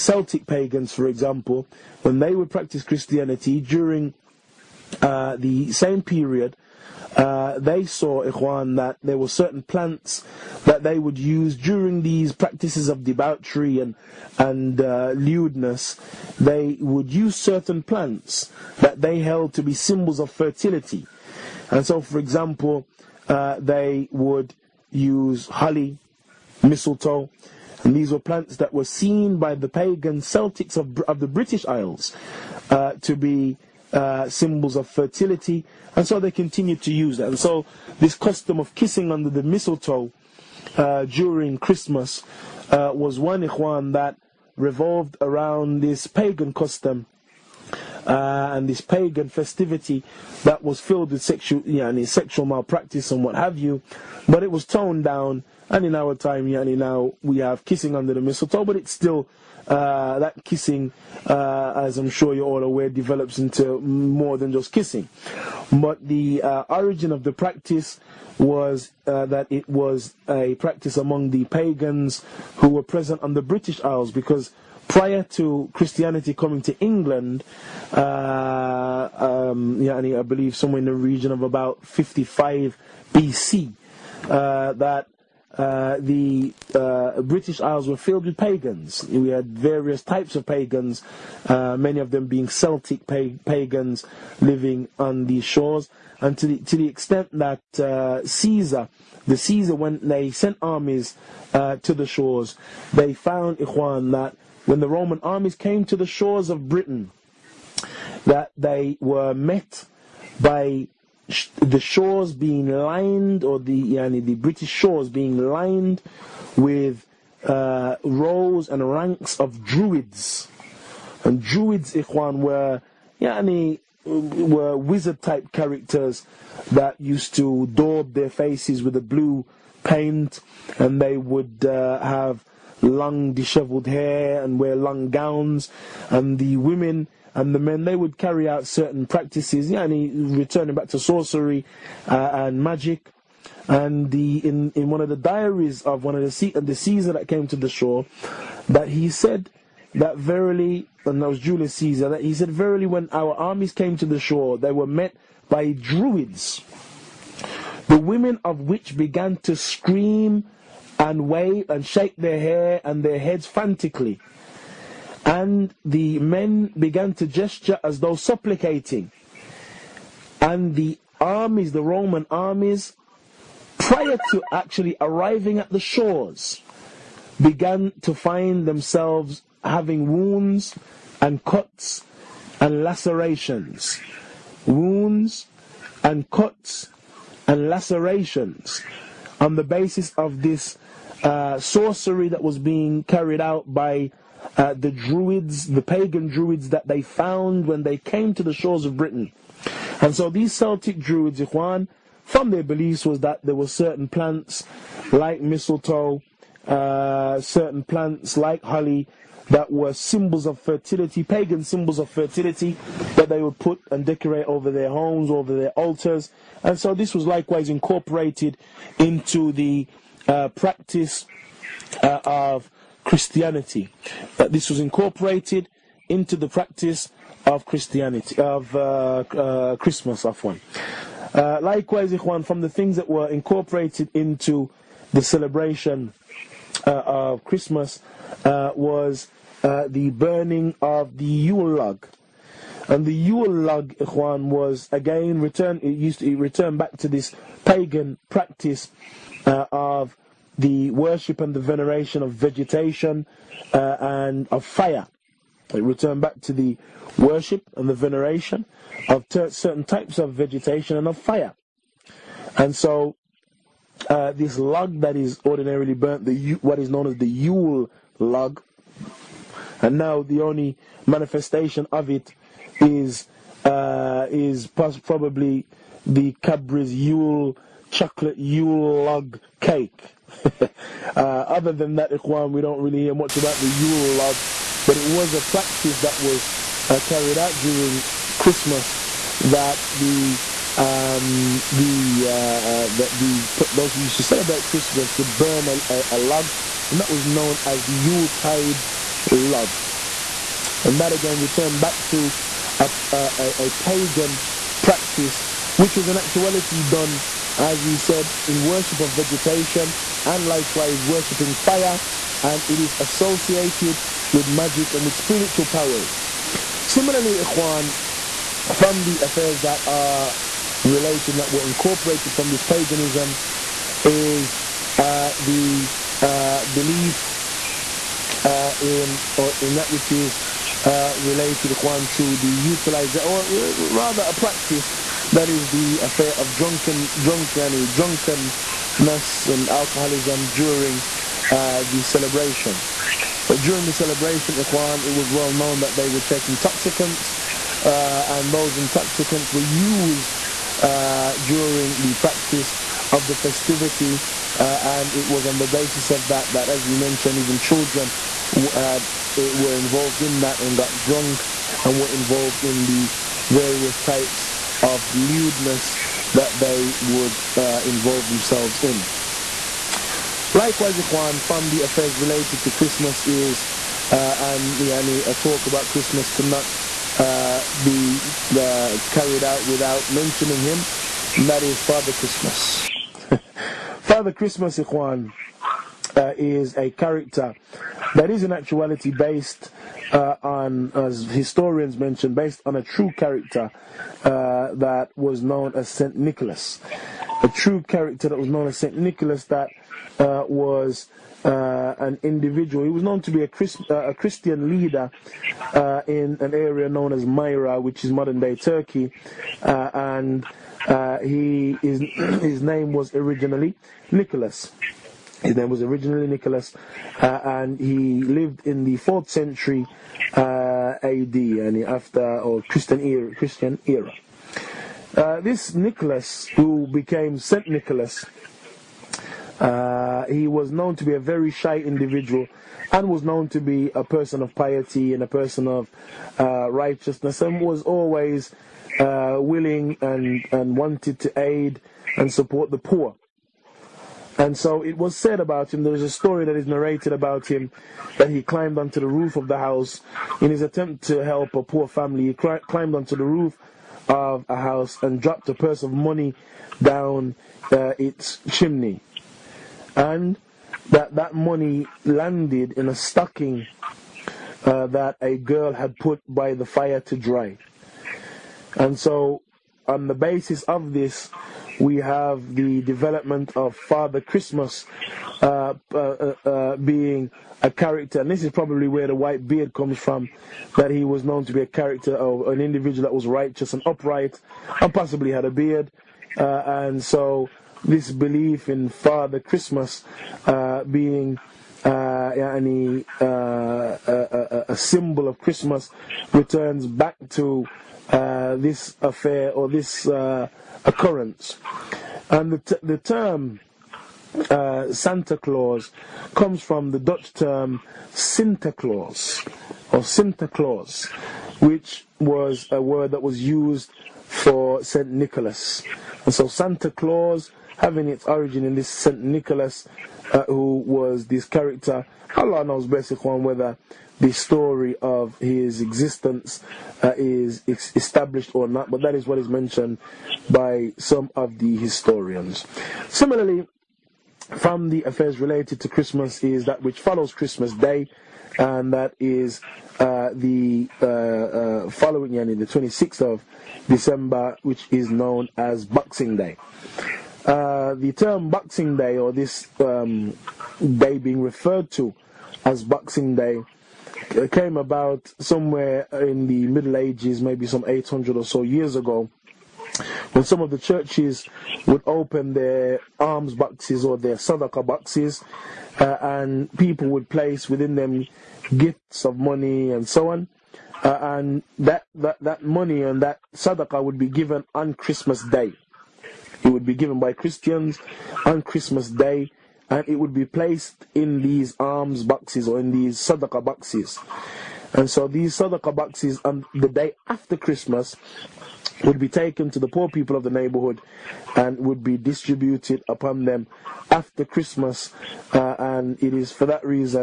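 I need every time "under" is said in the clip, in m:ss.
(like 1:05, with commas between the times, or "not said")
0:39, 0:57.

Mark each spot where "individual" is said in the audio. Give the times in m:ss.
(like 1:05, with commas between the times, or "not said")
6:42, 7:11, 8:02.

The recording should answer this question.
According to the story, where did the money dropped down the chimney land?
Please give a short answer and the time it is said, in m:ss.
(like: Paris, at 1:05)
A stocking, at 7:42.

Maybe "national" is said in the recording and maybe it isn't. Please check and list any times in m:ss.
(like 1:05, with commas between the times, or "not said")
not said.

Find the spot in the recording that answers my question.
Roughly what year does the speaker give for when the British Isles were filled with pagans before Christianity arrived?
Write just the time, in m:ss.
1:21.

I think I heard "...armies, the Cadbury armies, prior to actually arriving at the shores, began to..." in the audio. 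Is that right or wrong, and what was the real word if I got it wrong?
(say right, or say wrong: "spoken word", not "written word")
wrong: "Roman", not "Cadbury".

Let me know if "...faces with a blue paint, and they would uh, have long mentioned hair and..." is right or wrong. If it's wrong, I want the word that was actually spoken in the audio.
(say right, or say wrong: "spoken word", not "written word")
wrong: "dishevelled", not "mentioned".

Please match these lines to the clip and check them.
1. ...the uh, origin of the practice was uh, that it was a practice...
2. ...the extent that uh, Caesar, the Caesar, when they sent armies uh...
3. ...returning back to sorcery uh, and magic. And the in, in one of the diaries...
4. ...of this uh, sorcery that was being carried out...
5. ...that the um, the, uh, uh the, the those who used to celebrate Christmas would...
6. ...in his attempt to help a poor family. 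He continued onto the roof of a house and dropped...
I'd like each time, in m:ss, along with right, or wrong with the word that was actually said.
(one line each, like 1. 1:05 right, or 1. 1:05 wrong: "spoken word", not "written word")
1. 1:06 right
2. 1:36 right
3. 2:20 right
4. 3:10 right
5. 4:49 right
6. 7:30 wrong: "climbed", not "continued".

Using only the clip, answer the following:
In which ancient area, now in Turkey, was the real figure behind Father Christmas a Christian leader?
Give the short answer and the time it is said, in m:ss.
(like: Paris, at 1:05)
Myra, at 6:47.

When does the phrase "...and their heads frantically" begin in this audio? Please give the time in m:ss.
2:42.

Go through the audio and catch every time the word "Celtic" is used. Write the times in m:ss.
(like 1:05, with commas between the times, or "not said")
0:30, 1:32, 3:20.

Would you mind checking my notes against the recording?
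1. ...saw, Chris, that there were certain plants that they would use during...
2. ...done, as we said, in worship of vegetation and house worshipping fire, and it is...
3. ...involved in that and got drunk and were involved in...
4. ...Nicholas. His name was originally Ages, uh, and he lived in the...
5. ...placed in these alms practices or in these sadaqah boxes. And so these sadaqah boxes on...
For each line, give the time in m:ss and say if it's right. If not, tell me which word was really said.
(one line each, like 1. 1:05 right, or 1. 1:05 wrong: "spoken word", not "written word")
1. 0:07 wrong: "Ikhwan", not "Chris"
2. 5:06 wrong: "likewise", not "house"
3. 5:59 right
4. 6:54 wrong: "Nicholas", not "Ages"
5. 9:40 wrong: "boxes", not "practices".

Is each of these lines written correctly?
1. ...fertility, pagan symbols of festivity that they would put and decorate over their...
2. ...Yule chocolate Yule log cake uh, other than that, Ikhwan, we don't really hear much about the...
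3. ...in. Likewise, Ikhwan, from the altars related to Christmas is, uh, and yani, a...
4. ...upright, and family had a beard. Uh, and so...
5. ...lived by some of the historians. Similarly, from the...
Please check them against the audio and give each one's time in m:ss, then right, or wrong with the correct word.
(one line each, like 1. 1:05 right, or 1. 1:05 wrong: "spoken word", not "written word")
1. 3:30 wrong: "fertility", not "festivity"
2. 4:36 right
3. 6:08 wrong: "affairs", not "altars"
4. 8:03 wrong: "possibly", not "family"
5. 8:49 wrong: "mentioned", not "lived".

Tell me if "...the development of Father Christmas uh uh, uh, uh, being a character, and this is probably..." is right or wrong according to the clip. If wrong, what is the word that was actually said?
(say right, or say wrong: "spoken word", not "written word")
right.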